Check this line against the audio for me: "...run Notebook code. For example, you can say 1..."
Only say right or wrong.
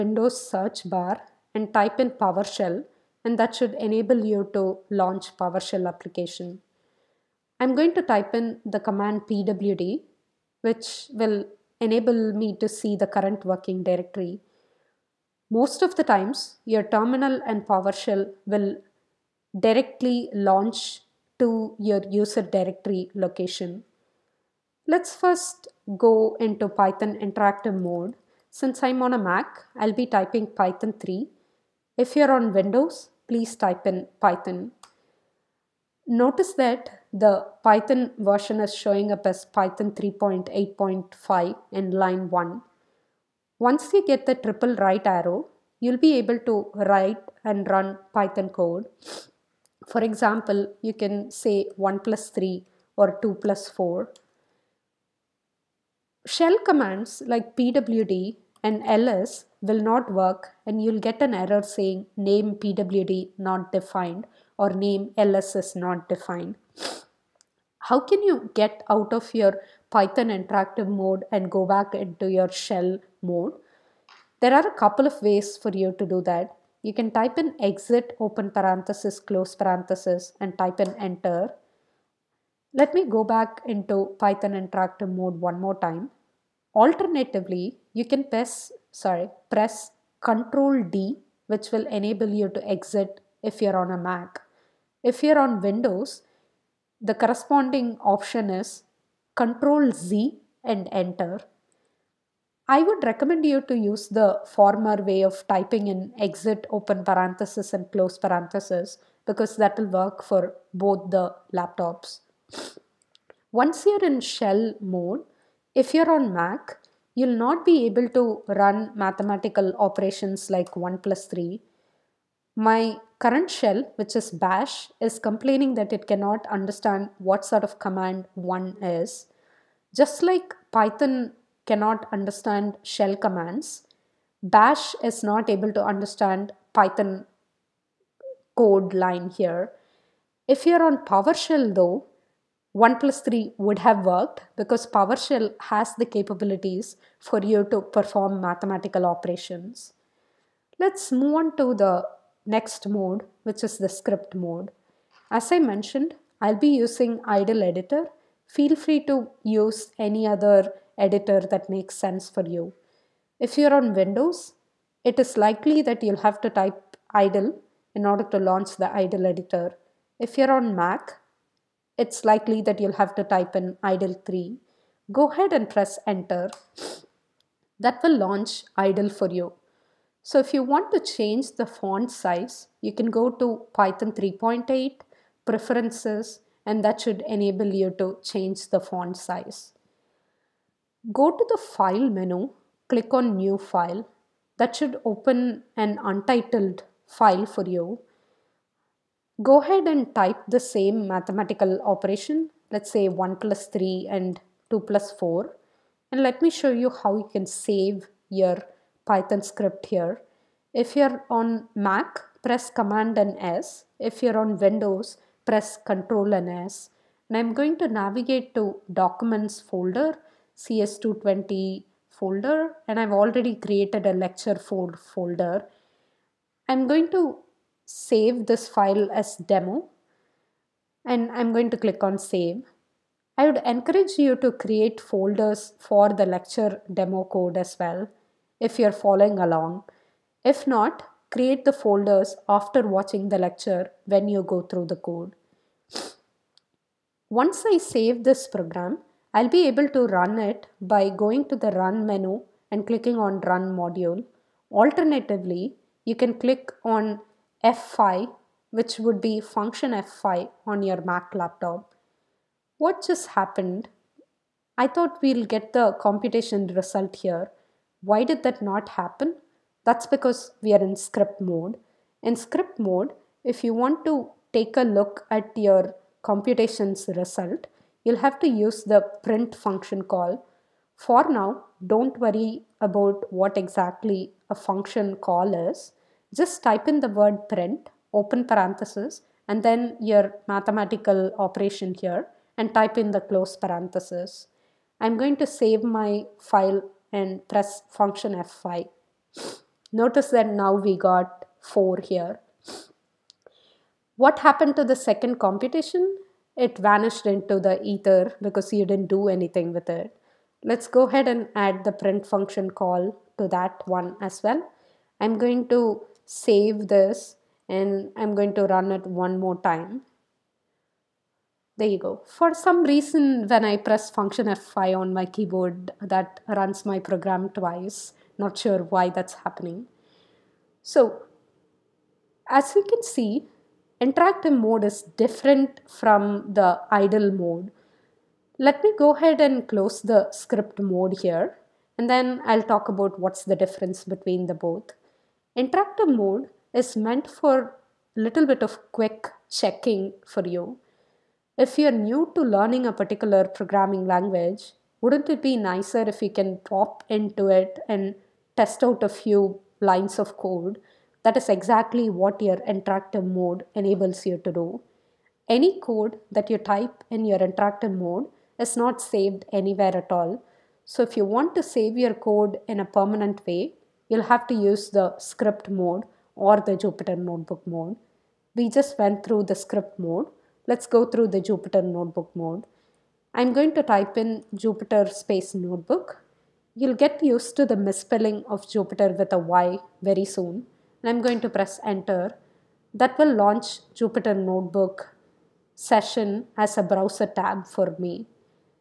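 wrong.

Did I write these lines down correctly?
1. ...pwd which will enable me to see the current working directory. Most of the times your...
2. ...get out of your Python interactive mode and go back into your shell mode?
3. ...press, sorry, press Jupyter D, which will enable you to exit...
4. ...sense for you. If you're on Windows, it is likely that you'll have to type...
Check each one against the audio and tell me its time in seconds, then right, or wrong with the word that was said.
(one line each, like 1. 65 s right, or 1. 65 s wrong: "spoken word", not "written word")
1. 9 s right
2. 68 s right
3. 88 s wrong: "Control", not "Jupyter"
4. 161 s right.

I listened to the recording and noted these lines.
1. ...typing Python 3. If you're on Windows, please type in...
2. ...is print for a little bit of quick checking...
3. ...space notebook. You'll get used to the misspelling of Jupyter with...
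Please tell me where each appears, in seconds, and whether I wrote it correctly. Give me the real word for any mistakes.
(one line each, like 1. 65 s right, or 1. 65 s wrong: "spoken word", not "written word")
1. 30 s right
2. 346 s wrong: "meant", not "print"
3. 385 s right.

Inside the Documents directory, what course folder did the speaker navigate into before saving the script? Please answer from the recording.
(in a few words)
CS220.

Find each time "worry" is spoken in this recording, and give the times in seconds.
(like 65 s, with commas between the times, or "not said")
282 s.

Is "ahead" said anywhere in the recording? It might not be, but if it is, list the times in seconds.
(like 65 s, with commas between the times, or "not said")
175 s, 199 s, 311 s, 339 s.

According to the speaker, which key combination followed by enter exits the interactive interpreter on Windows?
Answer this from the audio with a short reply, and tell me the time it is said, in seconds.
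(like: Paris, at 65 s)
Control Z, at 99 s.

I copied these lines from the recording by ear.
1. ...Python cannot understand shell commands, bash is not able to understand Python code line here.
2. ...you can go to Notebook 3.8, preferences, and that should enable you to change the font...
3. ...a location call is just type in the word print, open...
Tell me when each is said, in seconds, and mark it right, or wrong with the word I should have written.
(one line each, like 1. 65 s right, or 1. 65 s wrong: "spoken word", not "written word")
1. 130 s right
2. 182 s wrong: "Python", not "Notebook"
3. 284 s wrong: "function", not "location".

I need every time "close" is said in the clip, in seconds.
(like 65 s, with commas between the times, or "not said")
79 s, 107 s, 293 s, 339 s.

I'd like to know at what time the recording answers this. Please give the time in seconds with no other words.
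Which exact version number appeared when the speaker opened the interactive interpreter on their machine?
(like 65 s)
39 s.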